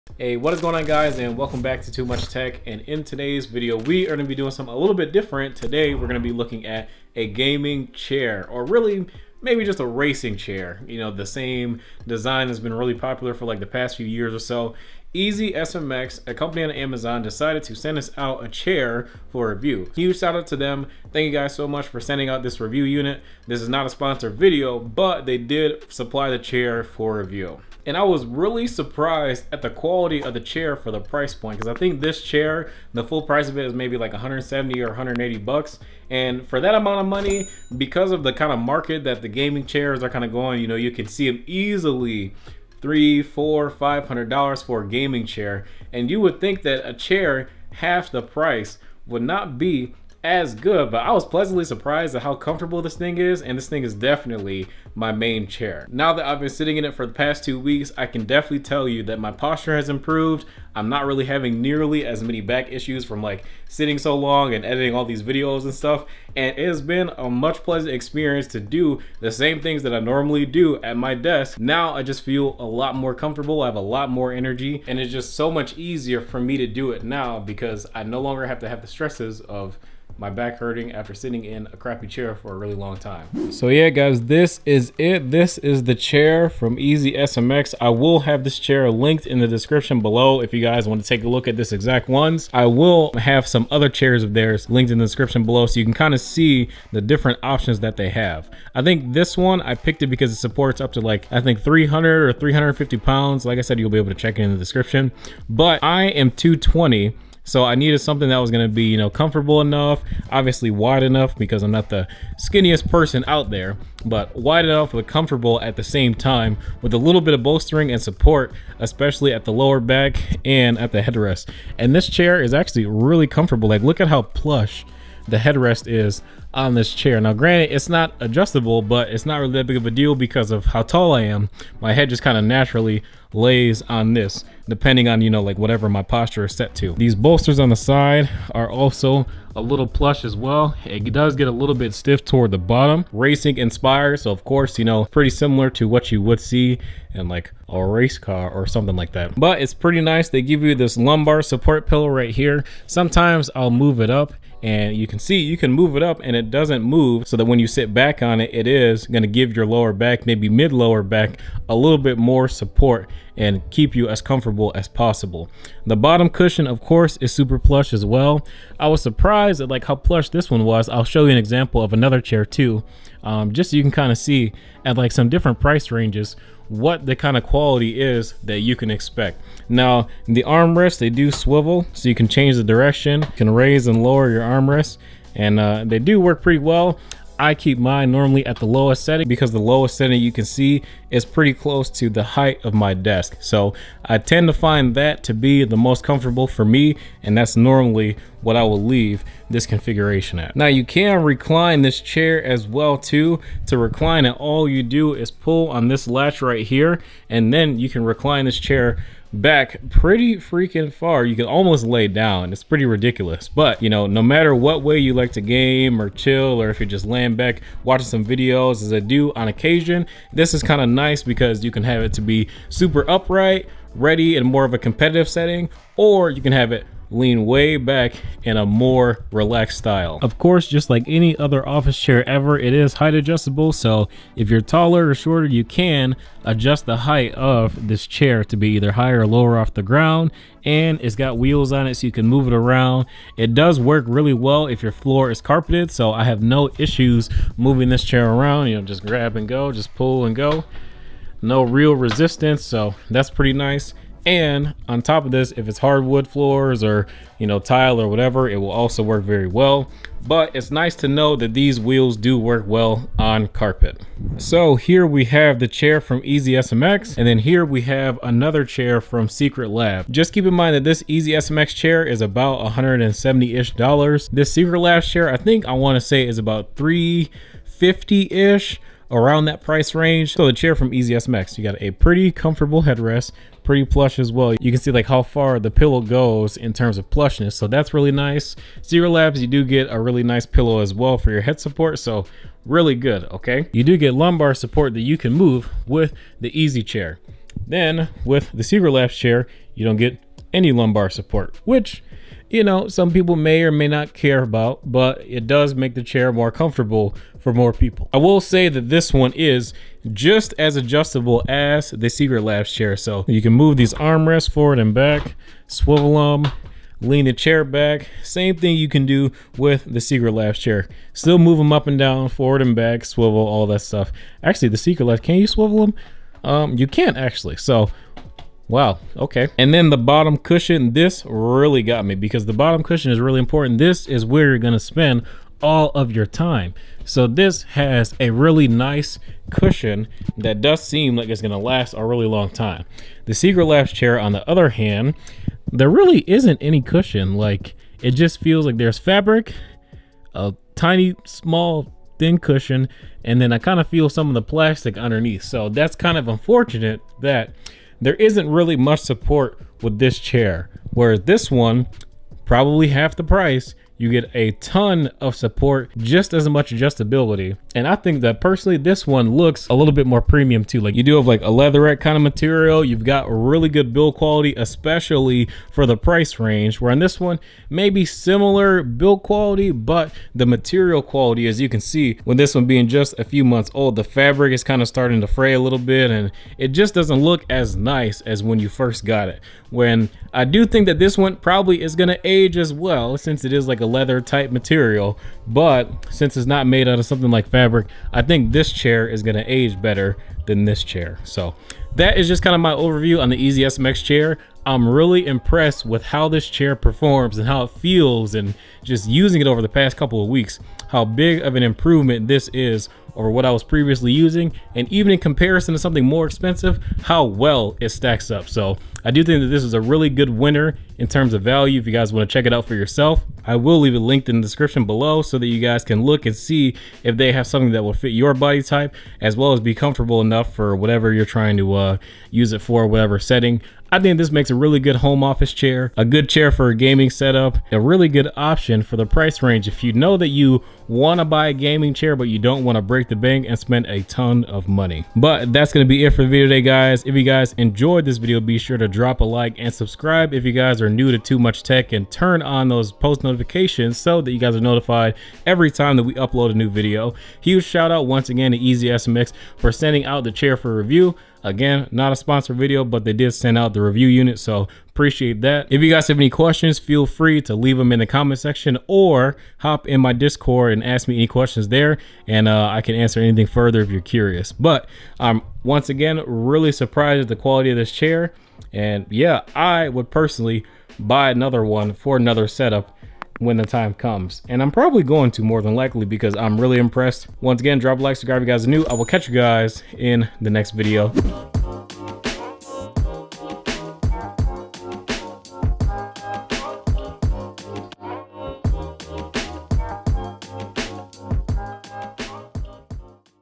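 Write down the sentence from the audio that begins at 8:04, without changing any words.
And I'm probably going to more than likely because I'm really impressed.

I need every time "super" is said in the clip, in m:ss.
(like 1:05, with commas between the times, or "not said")
2:47, 3:42.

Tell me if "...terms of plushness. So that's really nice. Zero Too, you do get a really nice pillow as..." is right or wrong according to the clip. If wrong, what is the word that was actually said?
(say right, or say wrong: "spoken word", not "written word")
wrong: "Labs", not "Too".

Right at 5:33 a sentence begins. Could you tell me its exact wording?
This is where you're gonna spend all of your time.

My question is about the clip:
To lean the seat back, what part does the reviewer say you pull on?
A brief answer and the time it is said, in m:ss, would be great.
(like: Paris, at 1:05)
latch, at 3:25.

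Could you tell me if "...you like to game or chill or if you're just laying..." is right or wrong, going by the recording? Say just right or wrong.
right.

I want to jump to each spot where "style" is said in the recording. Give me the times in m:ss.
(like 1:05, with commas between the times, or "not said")
3:49.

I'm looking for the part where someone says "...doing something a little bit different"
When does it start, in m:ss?
0:04.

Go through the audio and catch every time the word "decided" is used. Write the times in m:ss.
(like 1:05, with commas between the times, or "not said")
0:17.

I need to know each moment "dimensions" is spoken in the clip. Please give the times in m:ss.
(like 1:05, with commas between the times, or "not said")
not said.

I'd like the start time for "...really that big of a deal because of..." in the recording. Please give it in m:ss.
2:09.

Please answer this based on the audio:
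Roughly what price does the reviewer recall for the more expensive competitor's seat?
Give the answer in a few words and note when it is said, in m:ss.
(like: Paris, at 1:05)
$350, at 4:36.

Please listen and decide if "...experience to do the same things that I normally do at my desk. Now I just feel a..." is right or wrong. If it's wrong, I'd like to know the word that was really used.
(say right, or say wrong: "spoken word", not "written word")
right.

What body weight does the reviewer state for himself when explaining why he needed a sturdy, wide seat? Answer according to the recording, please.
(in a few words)
220.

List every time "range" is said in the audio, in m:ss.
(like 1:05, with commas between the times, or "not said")
2:55, 4:39, 6:16, 7:19.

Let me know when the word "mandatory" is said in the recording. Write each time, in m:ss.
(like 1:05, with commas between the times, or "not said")
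not said.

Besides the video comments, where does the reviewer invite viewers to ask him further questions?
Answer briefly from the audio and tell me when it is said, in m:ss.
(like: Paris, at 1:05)
Discord, at 7:49.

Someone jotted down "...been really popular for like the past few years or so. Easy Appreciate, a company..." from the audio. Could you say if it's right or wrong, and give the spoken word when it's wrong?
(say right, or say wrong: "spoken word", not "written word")
wrong: "SMX", not "Appreciate".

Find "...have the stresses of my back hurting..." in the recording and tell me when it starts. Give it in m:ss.
1:18.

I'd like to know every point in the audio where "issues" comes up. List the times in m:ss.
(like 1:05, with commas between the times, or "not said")
1:02, 4:06.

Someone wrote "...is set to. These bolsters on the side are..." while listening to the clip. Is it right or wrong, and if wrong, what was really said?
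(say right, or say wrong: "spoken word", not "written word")
right.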